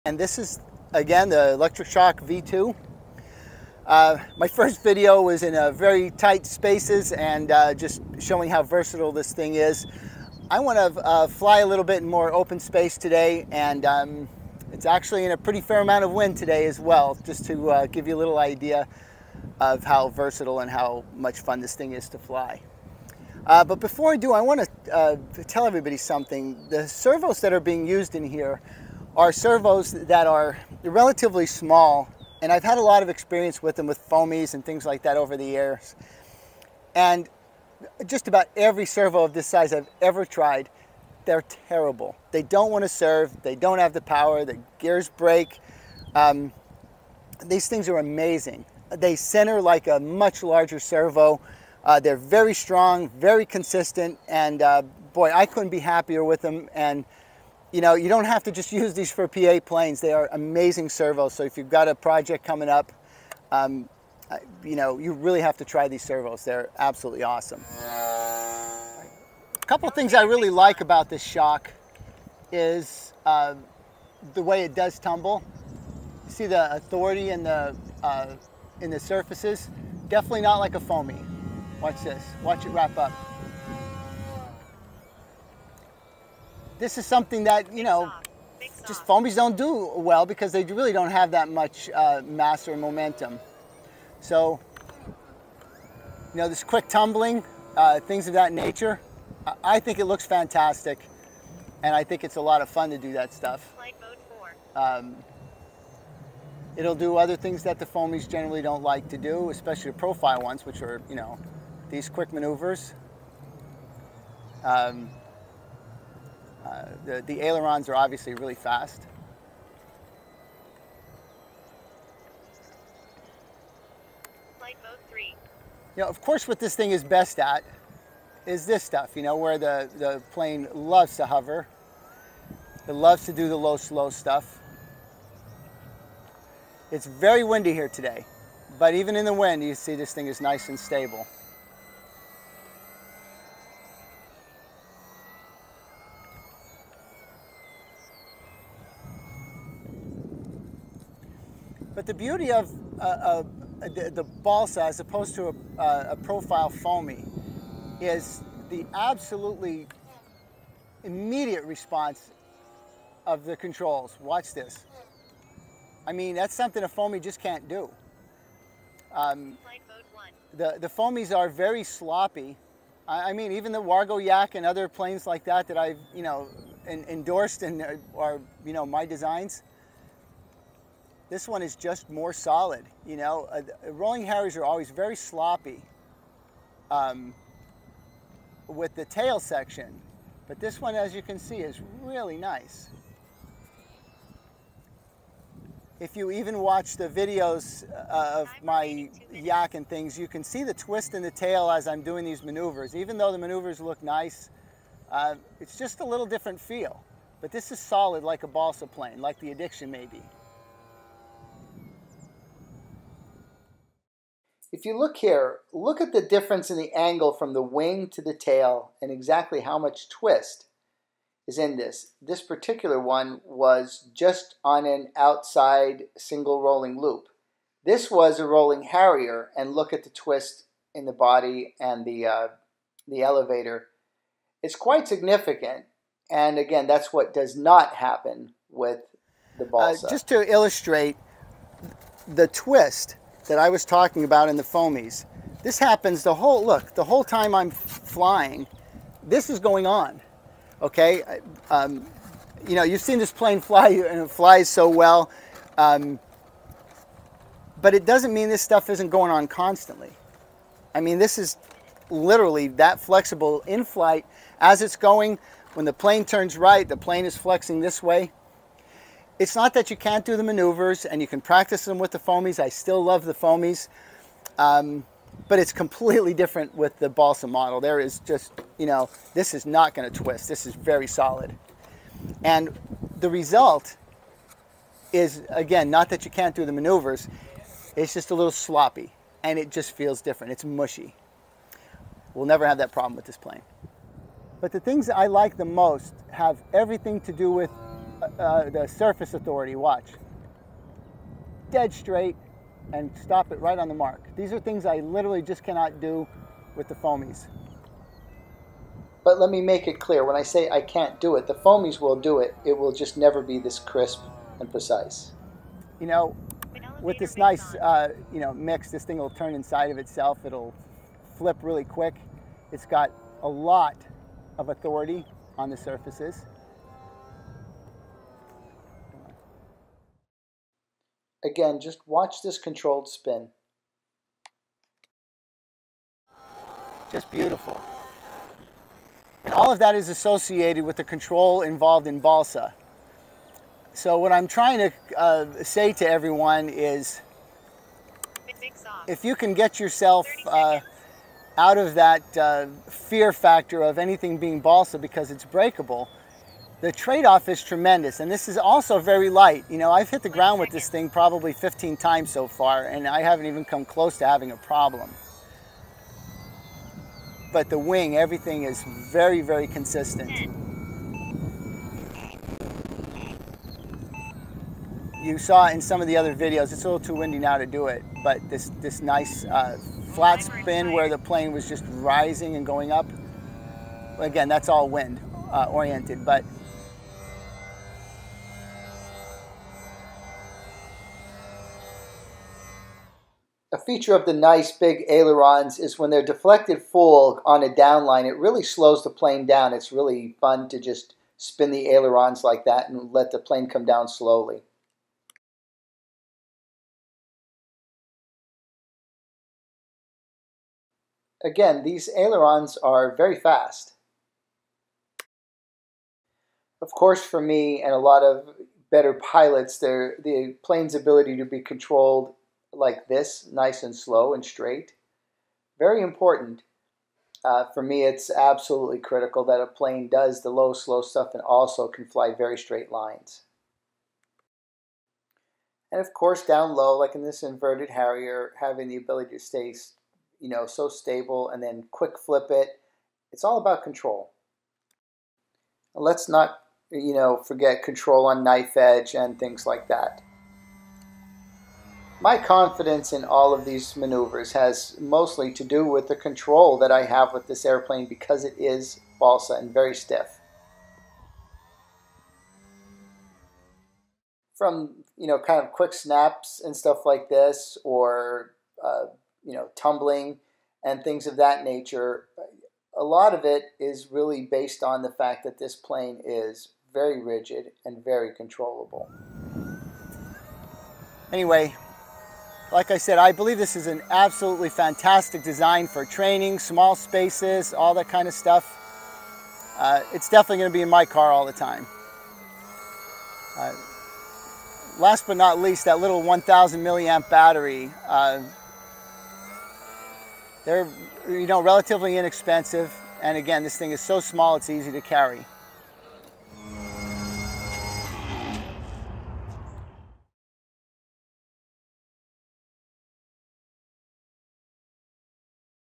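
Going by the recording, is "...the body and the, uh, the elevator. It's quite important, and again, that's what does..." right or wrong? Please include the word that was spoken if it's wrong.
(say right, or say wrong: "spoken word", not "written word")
wrong: "significant", not "important".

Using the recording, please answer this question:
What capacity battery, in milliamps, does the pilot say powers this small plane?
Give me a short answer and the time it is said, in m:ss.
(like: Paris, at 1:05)
1,000 milliamp, at 8:16.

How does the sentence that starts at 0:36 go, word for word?
And just about every servo of this size I've ever tried, they're terrible.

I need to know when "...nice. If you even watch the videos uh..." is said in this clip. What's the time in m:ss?
3:12.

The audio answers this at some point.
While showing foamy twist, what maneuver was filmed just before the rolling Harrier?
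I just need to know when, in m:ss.
3:45.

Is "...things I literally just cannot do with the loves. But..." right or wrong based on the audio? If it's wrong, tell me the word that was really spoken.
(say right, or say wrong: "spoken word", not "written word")
wrong: "foamies", not "loves".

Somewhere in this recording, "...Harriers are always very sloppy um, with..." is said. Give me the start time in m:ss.
3:04.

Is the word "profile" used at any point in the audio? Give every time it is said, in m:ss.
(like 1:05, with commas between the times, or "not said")
1:49, 2:36.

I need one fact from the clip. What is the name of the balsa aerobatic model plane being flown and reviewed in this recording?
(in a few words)
Electric Shock V2.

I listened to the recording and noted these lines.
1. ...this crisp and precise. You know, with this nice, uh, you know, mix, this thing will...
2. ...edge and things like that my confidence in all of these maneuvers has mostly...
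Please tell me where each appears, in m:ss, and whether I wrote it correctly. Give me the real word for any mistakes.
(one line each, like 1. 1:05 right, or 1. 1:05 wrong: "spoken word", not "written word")
1. 5:13 right
2. 7:28 right.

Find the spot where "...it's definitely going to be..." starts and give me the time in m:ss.
8:10.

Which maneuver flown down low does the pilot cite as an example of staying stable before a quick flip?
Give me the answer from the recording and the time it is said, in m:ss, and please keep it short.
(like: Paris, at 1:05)
Inverted Harrier, at 7:17.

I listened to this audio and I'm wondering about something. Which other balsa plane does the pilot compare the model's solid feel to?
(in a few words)
Addiction.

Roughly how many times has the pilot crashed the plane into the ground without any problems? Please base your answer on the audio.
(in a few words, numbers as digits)
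15.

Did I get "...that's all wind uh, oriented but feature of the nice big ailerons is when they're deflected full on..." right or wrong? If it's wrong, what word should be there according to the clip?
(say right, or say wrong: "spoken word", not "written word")
right.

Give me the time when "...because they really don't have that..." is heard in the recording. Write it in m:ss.
1:30.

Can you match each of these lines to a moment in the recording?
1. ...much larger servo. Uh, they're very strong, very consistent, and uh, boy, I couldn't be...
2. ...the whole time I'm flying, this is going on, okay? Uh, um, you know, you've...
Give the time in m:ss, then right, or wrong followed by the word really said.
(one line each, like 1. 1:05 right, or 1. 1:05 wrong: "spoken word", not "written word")
1. 0:49 right
2. 4:06 right.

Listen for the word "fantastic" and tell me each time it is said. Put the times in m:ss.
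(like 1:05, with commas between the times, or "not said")
1:40, 8:04.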